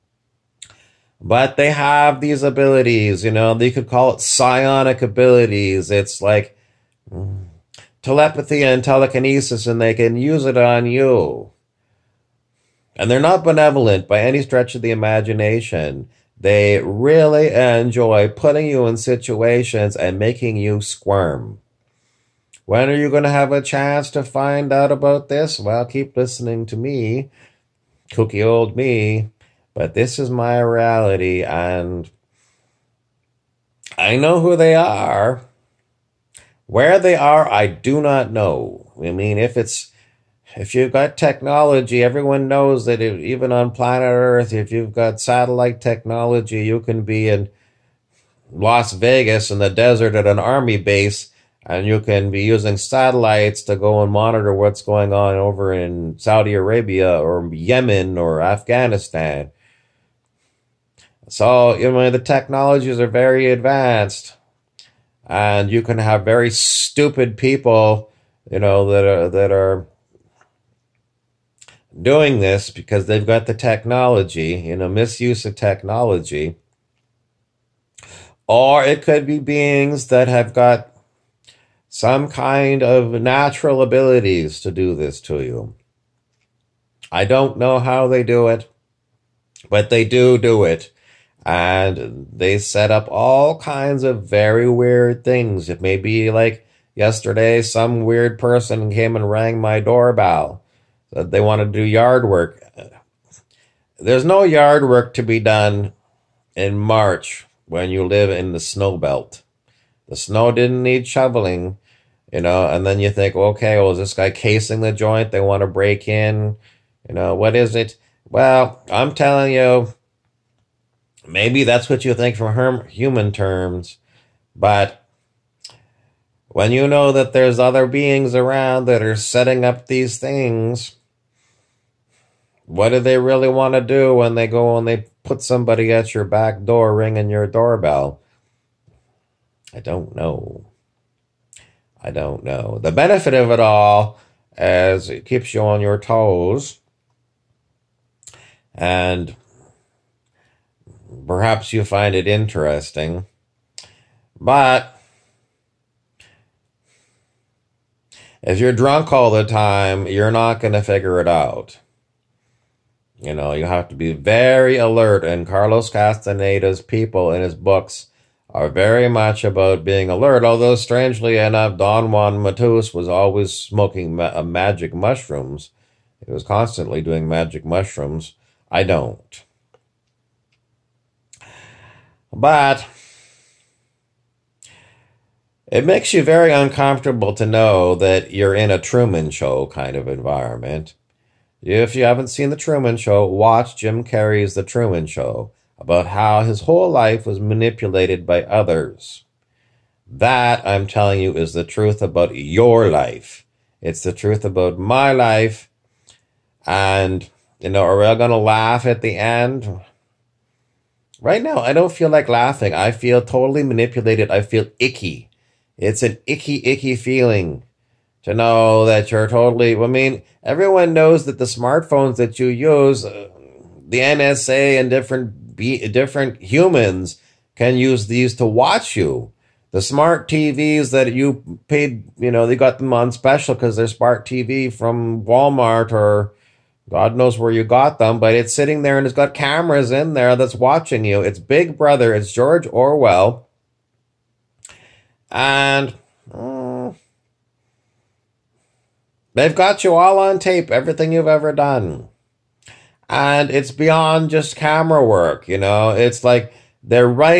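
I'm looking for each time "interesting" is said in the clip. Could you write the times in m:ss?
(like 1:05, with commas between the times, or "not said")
2:32.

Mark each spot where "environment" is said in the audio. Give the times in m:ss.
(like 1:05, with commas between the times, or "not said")
3:10.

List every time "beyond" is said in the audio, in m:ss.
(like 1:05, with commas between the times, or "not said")
4:13.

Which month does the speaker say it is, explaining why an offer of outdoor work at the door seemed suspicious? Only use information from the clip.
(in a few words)
March.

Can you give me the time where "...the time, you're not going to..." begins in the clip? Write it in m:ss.
2:39.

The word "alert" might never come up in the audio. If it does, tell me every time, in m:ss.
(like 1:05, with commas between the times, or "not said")
2:44, 2:50.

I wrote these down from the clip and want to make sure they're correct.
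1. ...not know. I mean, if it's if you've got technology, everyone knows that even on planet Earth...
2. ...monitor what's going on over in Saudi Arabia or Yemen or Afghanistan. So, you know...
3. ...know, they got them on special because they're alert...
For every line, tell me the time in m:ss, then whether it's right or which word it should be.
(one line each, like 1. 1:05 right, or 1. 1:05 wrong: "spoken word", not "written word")
1. 0:38 right
2. 0:54 right
3. 3:52 wrong: "smart", not "alert".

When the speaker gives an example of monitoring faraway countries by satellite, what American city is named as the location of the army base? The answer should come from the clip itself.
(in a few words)
Las Vegas.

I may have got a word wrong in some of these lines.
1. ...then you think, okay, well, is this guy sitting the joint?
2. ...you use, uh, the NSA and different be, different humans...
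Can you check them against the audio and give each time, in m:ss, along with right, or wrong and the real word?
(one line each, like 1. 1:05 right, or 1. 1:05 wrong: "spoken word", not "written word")
1. 1:52 wrong: "casing", not "sitting"
2. 3:42 right.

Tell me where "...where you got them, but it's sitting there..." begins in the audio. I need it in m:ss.
3:57.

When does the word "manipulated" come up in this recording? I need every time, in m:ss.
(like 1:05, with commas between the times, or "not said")
3:17, 3:33.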